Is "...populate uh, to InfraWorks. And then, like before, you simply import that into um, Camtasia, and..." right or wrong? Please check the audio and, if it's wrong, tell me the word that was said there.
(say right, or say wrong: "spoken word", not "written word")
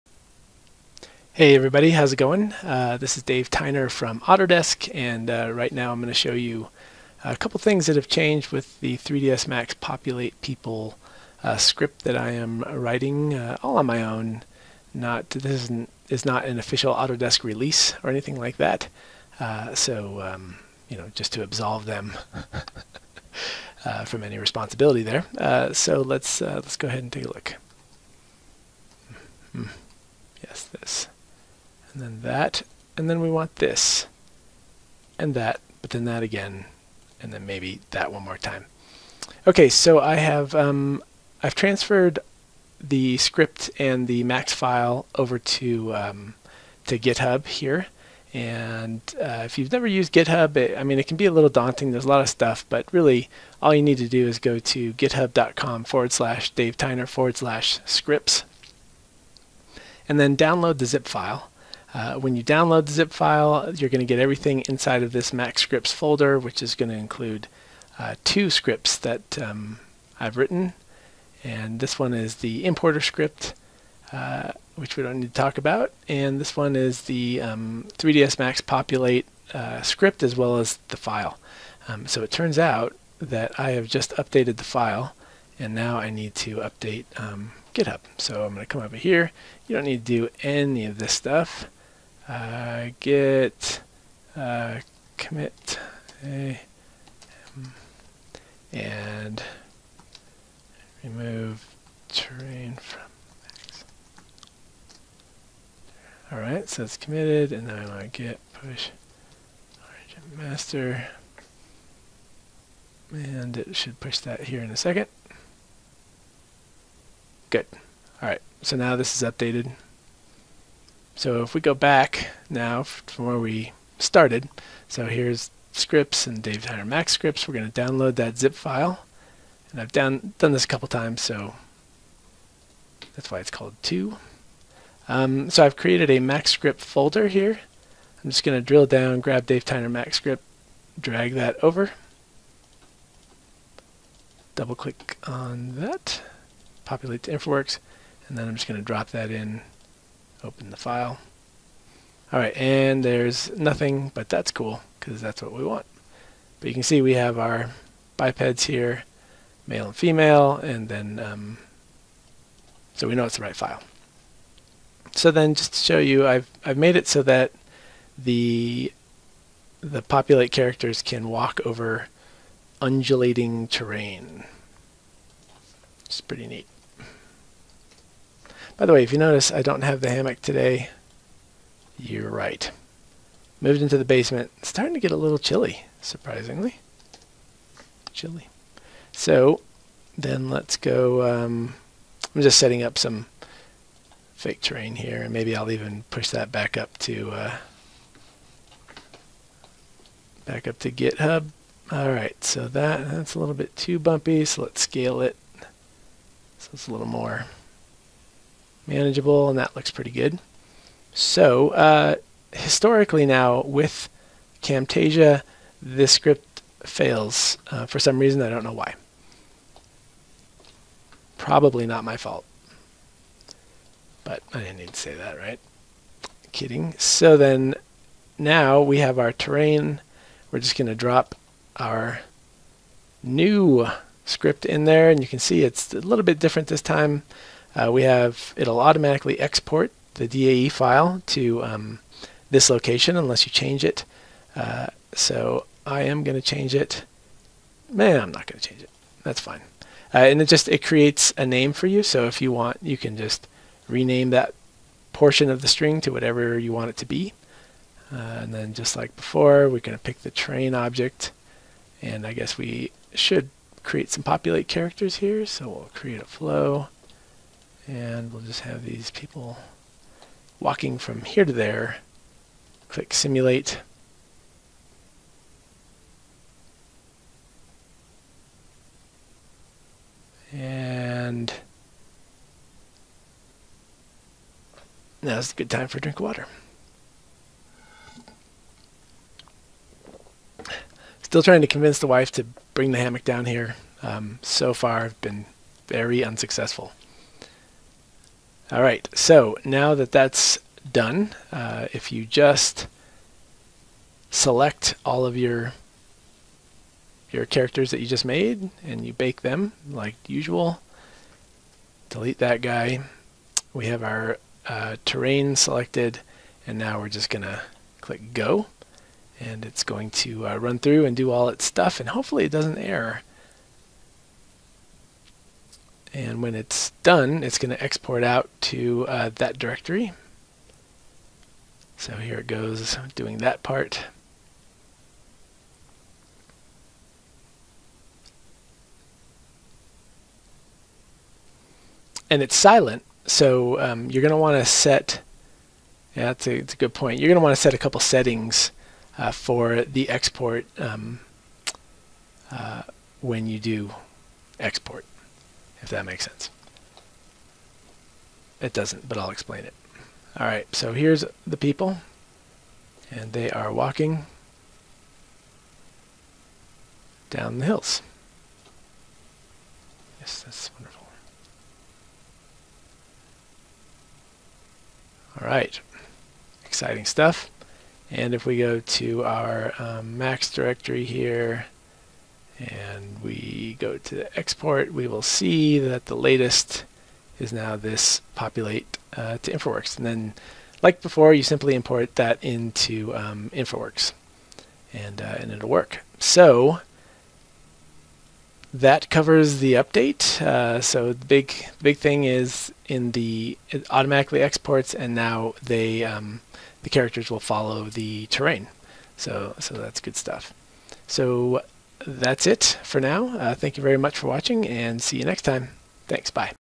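wrong: "InfraWorks", not "Camtasia".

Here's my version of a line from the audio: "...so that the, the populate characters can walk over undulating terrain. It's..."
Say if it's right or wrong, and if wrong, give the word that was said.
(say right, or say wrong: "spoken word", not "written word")
right.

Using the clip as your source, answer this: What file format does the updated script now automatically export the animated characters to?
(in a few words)
DAE.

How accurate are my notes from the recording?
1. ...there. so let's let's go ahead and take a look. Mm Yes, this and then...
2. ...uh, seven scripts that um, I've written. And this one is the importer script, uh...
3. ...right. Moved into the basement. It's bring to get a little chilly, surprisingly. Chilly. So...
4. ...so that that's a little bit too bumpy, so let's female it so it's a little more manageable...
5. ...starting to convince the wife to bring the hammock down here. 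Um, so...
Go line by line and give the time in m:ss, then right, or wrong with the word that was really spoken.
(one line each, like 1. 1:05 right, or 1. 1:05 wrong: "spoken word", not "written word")
1. 0:25 right
2. 1:07 wrong: "two", not "seven"
3. 3:02 wrong: "starting", not "bring"
4. 3:22 wrong: "scale", not "female"
5. 4:51 wrong: "trying", not "starting".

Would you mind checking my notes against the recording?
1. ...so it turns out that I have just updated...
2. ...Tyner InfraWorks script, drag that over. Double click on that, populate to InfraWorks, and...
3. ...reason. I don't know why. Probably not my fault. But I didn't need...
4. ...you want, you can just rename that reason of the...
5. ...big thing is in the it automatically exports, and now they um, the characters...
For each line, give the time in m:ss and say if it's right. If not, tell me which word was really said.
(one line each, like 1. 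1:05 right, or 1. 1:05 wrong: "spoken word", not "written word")
1. 1:22 right
2. 2:19 wrong: "Max", not "InfraWorks"
3. 3:38 right
4. 4:12 wrong: "portion", not "reason"
5. 6:41 right.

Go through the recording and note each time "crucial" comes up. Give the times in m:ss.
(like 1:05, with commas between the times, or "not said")
not said.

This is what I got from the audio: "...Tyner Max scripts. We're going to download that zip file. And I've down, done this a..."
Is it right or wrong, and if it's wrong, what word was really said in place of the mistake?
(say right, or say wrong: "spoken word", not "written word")
right.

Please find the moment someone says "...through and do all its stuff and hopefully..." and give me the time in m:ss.
5:20.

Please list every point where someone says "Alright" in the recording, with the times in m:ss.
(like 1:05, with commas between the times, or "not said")
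1:46, 1:58.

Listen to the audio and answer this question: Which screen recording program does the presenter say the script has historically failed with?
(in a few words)
Camtasia.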